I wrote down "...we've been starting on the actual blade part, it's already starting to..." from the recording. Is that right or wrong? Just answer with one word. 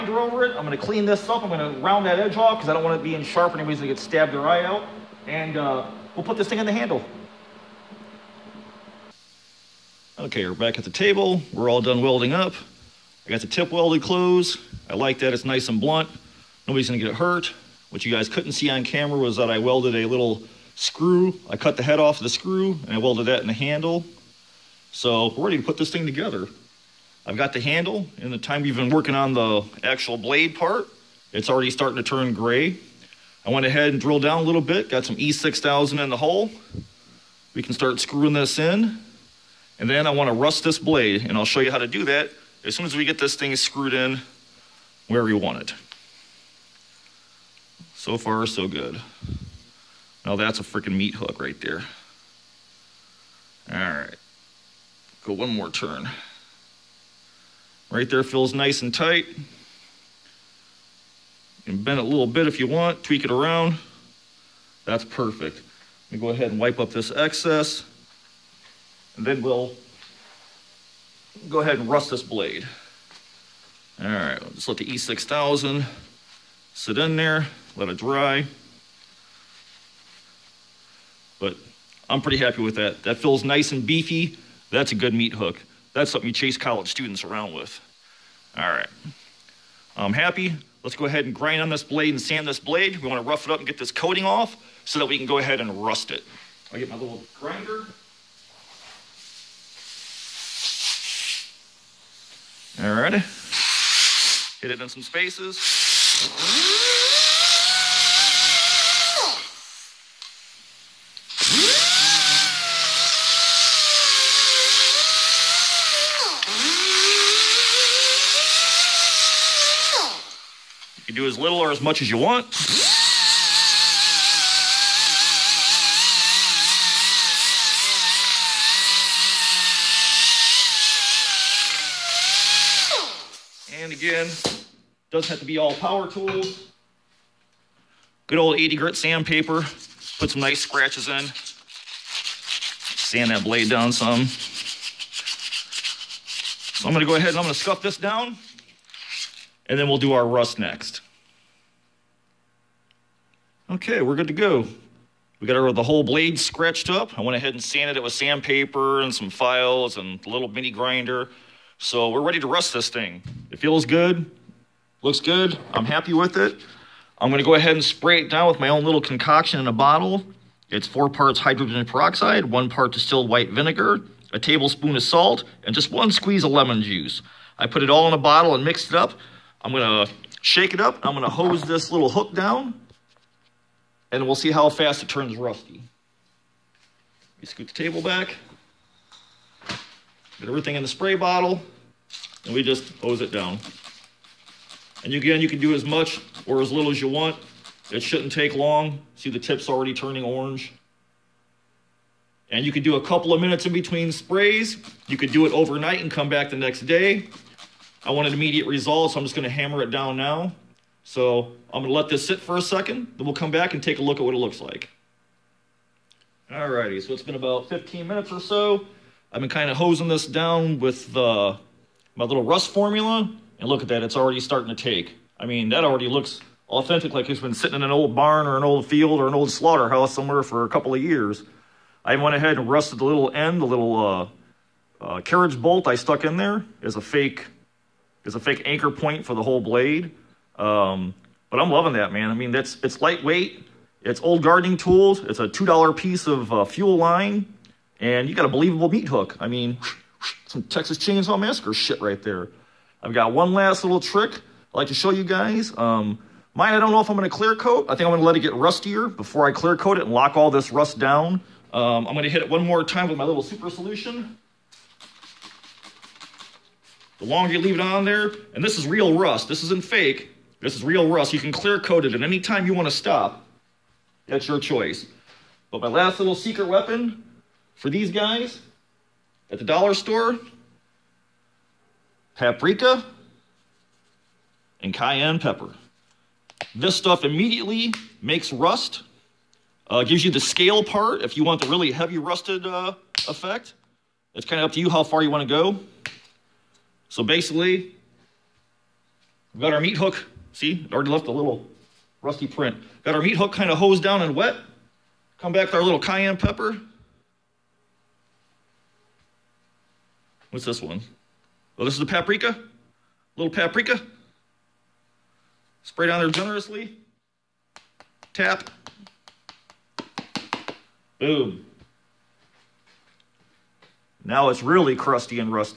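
wrong.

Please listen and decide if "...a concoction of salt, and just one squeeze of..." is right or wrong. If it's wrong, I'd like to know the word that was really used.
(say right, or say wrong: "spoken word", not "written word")
wrong: "tablespoon", not "concoction".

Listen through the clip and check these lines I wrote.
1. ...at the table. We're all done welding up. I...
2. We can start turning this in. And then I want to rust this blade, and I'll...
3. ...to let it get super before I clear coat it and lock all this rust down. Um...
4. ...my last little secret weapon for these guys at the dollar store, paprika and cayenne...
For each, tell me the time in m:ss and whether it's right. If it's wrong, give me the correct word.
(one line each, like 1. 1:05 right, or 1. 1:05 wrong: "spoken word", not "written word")
1. 0:10 right
2. 0:37 wrong: "screwing", not "turning"
3. 4:18 wrong: "rustier", not "super"
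4. 4:35 right.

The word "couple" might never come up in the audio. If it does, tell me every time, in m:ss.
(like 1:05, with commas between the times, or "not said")
3:23, 3:50.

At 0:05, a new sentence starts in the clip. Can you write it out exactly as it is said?
And uh, We'll put this thing on the handle.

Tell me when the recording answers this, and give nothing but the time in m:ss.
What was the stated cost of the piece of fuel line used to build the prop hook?
4:05.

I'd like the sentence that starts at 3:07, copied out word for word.
Let me scoot the table back.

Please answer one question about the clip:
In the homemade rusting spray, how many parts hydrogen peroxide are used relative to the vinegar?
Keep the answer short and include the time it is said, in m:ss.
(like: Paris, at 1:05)
4, at 2:50.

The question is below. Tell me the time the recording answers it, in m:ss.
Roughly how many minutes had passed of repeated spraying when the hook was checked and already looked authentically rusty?
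3:37.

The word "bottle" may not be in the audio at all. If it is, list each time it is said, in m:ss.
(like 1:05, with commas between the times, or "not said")
2:49, 2:58, 3:11.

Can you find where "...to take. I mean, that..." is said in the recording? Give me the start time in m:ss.
3:44.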